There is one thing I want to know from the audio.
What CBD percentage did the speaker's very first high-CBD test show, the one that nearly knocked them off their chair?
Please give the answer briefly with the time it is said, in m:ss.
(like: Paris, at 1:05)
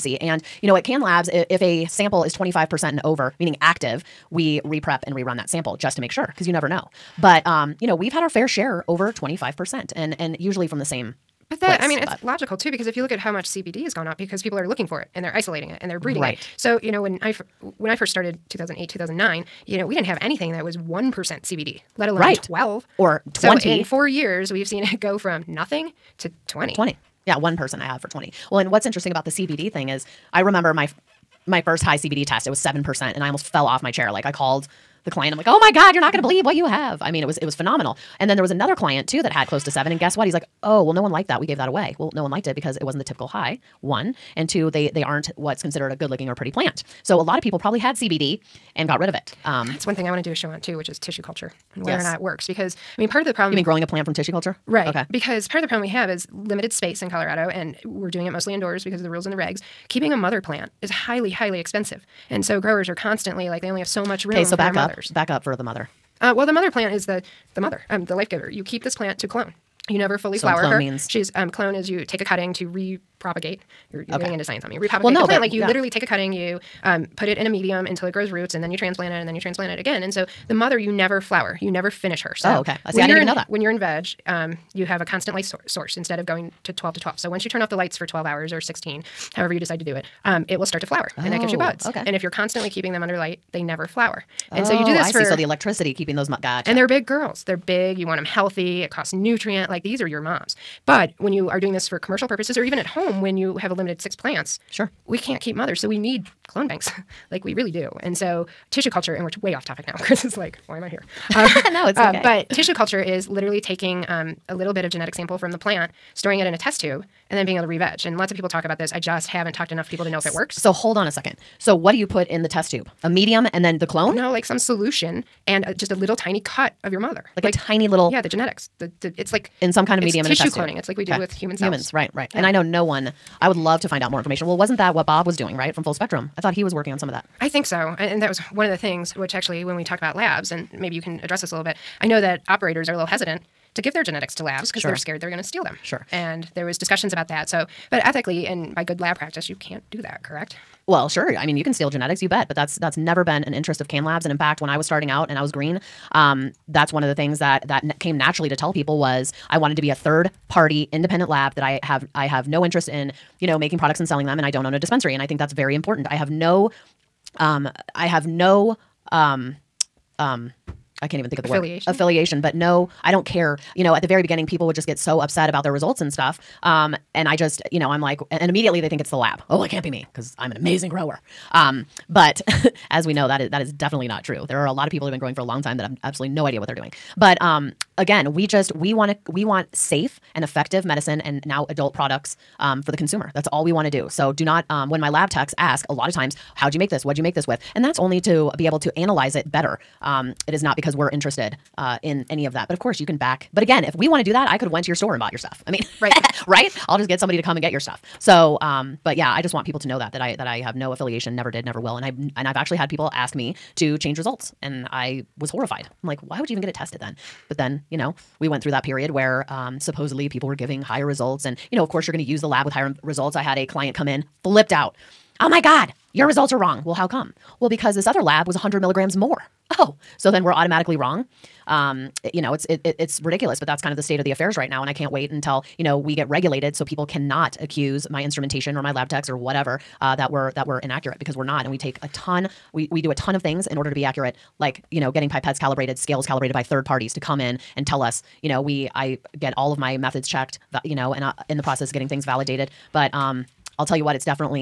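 7%, at 0:32.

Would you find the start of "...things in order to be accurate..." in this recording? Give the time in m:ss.
4:03.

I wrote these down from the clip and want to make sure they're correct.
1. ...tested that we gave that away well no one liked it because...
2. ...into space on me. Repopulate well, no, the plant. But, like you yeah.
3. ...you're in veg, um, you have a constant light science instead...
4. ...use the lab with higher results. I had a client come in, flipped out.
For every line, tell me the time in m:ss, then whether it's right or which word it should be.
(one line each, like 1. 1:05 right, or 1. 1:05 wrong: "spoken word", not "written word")
1. 0:41 wrong: "liked", not "tested"
2. 1:14 wrong: "science", not "space"
3. 1:23 wrong: "source", not "science"
4. 3:42 right.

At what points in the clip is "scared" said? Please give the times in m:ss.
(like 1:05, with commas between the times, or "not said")
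2:24.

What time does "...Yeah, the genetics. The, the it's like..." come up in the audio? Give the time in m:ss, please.
2:08.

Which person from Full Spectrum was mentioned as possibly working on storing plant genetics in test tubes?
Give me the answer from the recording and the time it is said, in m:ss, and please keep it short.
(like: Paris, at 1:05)
Bob, at 2:15.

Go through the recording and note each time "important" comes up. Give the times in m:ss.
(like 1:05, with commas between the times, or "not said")
2:45.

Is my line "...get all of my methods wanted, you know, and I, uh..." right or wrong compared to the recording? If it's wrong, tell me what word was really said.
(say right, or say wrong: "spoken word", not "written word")
wrong: "checked", not "wanted".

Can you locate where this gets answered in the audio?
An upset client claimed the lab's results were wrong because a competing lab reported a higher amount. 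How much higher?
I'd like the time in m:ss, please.
3:48.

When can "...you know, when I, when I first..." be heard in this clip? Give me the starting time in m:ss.
0:16.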